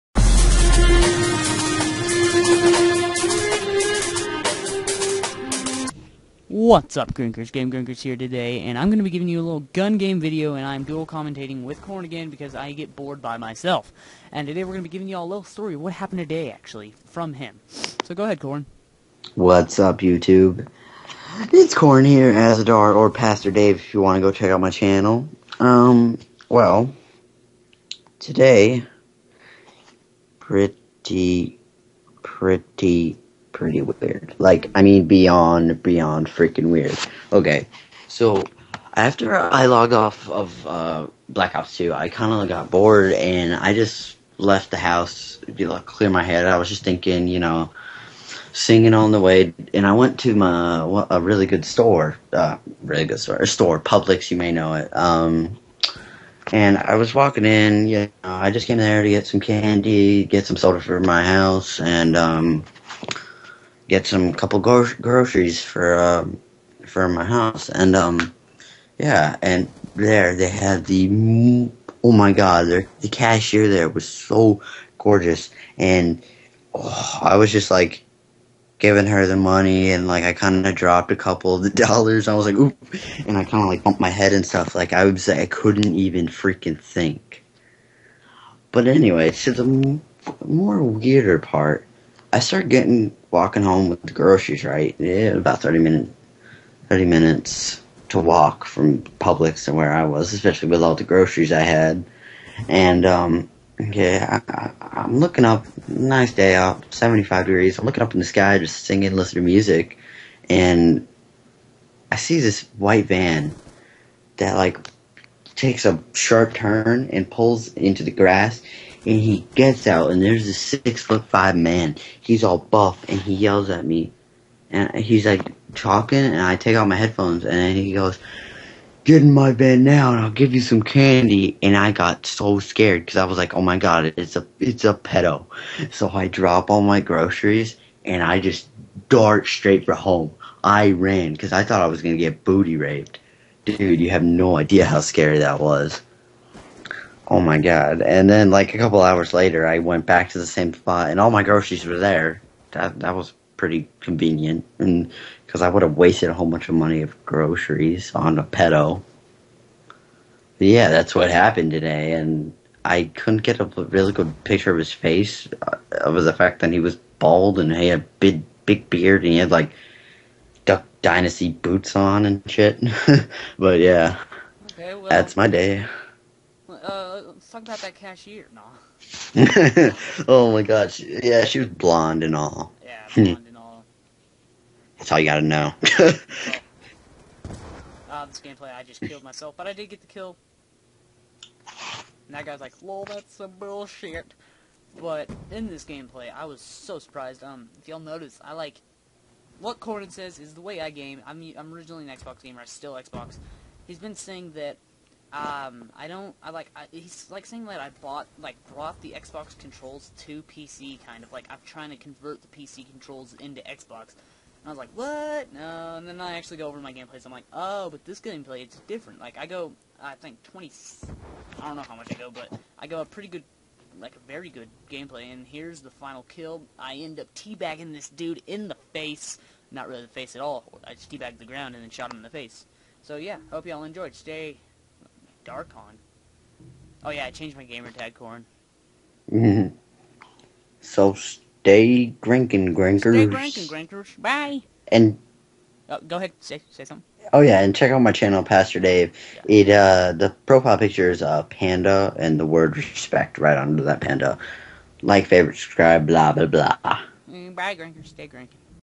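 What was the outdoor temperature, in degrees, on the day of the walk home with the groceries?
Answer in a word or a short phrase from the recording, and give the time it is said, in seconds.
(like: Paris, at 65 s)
75, at 106 s.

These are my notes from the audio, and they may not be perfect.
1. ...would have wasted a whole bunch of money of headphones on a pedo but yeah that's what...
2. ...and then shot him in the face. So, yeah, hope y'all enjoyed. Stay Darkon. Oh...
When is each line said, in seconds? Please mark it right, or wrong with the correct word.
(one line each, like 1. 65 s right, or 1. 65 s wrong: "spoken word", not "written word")
1. 155 s wrong: "groceries", not "headphones"
2. 231 s right.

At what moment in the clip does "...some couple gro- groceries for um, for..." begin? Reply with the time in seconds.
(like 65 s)
64 s.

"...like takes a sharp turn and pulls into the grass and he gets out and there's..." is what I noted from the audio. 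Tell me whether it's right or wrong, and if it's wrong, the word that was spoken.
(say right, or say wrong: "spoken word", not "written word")
right.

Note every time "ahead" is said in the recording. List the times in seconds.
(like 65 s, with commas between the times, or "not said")
18 s, 246 s.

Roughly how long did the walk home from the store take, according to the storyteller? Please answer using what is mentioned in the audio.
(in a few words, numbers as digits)
30 minutes.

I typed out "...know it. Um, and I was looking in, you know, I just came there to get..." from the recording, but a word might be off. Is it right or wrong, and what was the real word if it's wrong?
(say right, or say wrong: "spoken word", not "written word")
wrong: "walking", not "looking".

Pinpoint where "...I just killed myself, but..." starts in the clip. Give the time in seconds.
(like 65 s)
188 s.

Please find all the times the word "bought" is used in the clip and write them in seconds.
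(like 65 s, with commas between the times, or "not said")
208 s.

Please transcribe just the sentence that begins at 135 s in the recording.
So I drop all my groceries and I just dart straight for home.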